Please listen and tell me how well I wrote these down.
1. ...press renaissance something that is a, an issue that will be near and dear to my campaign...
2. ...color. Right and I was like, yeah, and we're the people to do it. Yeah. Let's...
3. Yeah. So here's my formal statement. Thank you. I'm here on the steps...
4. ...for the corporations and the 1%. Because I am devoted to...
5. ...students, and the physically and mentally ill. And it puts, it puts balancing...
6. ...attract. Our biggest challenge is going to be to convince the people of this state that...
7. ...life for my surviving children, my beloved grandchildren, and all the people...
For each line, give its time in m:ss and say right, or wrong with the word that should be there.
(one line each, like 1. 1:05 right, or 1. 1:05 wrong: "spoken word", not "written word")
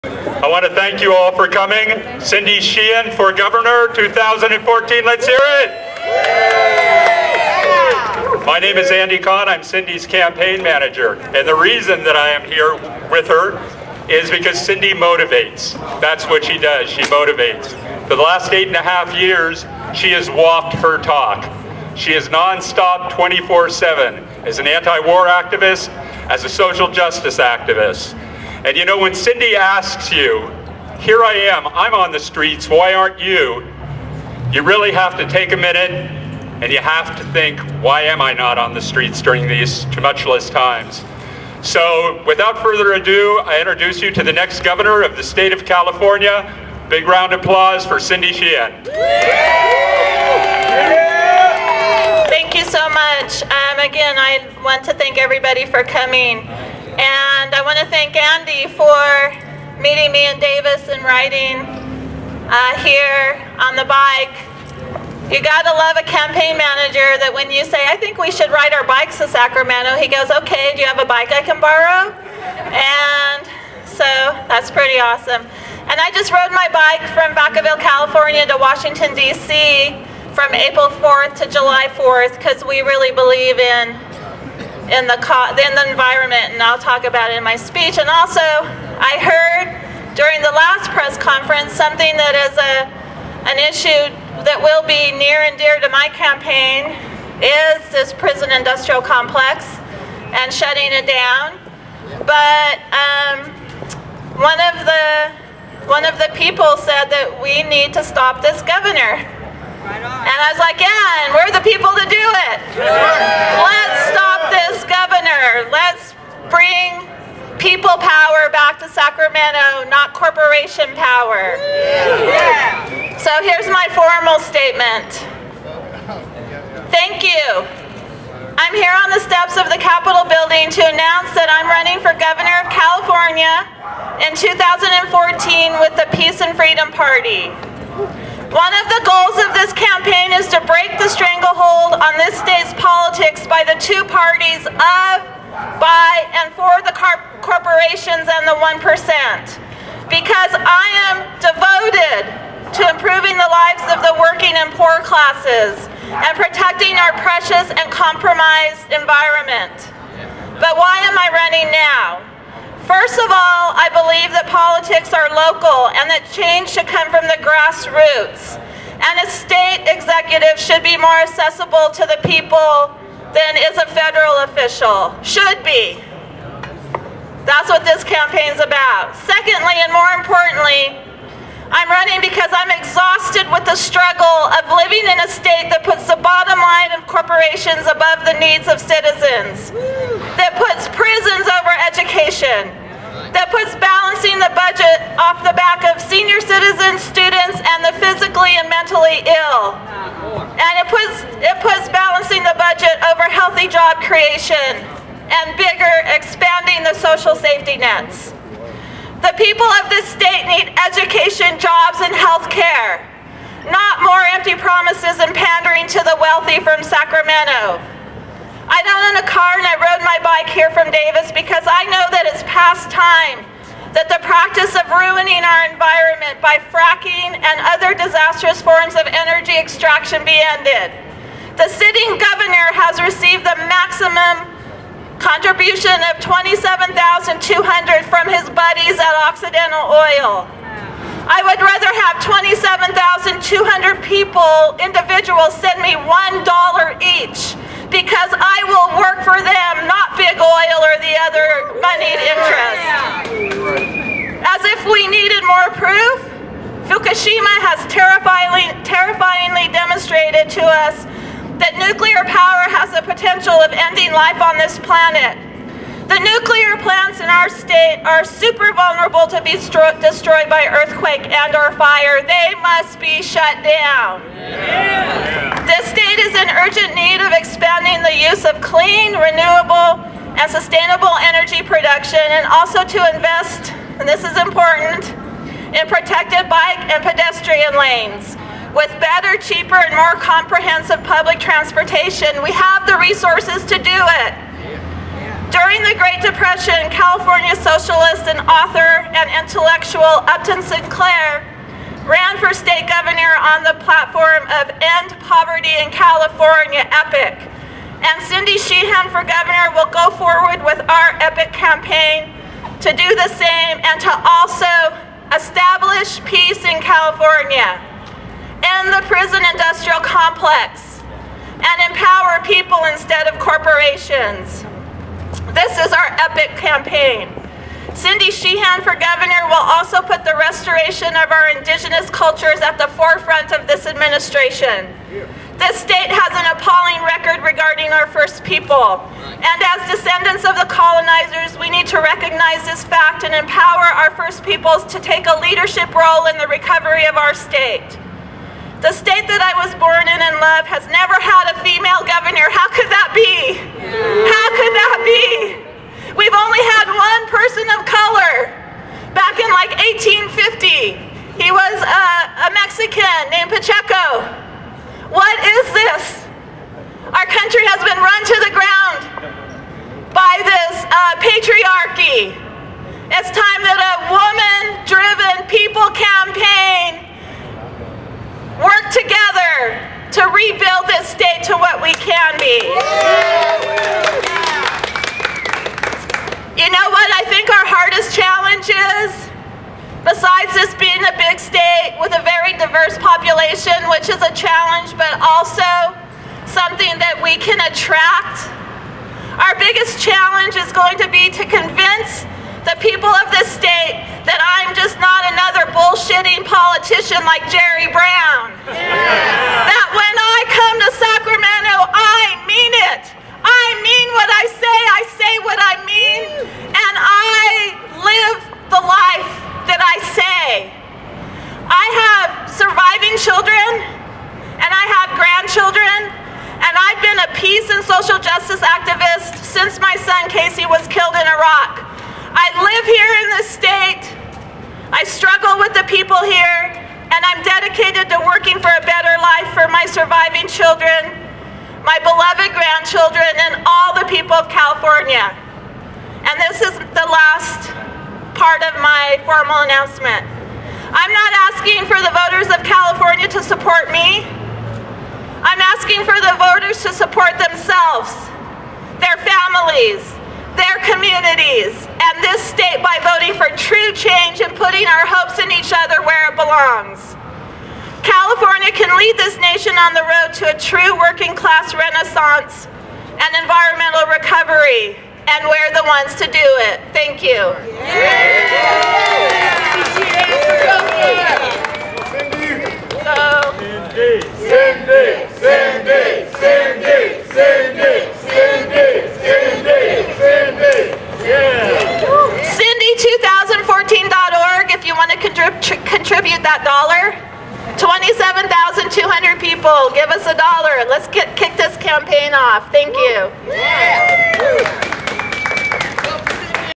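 1. 1:30 wrong: "conference", not "renaissance"
2. 1:48 wrong: "governor", not "color"
3. 2:01 right
4. 2:26 right
5. 3:16 right
6. 6:37 right
7. 7:19 right.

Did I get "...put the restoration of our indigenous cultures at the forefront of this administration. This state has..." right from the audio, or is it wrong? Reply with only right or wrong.
right.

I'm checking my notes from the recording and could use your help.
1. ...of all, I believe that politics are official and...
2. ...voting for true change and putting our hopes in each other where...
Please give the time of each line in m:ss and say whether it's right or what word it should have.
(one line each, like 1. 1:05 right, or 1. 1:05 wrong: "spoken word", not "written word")
1. 2:43 wrong: "local", not "official"
2. 7:43 right.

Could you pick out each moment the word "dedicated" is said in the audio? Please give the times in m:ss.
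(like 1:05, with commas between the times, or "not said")
7:17.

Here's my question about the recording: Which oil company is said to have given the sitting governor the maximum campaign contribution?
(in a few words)
Occidental Oil.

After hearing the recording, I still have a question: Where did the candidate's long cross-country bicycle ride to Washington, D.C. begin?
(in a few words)
Vacaville.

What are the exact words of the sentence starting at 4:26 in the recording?
The nuclear plants in our state are super vulnerable to be destroyed by earthquake and or fire.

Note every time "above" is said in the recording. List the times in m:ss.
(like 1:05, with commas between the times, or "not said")
3:07.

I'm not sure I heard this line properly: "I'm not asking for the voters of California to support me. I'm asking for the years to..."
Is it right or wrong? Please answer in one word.
wrong.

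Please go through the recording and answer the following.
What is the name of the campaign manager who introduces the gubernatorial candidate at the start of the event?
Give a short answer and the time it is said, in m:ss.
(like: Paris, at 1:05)
Andy Kahn, at 0:08.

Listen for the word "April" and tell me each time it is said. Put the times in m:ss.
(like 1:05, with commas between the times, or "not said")
1:20.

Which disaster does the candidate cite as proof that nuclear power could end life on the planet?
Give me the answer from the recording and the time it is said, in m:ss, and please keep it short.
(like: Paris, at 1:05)
Fukushima, at 4:16.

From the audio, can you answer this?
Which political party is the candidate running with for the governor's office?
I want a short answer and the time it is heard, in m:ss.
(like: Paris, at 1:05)
Peace and Freedom Party, at 2:16.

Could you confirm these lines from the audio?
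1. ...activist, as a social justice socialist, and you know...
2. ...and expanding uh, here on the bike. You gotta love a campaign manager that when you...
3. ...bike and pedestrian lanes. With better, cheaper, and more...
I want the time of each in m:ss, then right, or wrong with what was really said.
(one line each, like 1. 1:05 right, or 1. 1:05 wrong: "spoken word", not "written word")
1. 0:25 wrong: "activist", not "socialist"
2. 1:00 wrong: "riding", not "expanding"
3. 4:46 right.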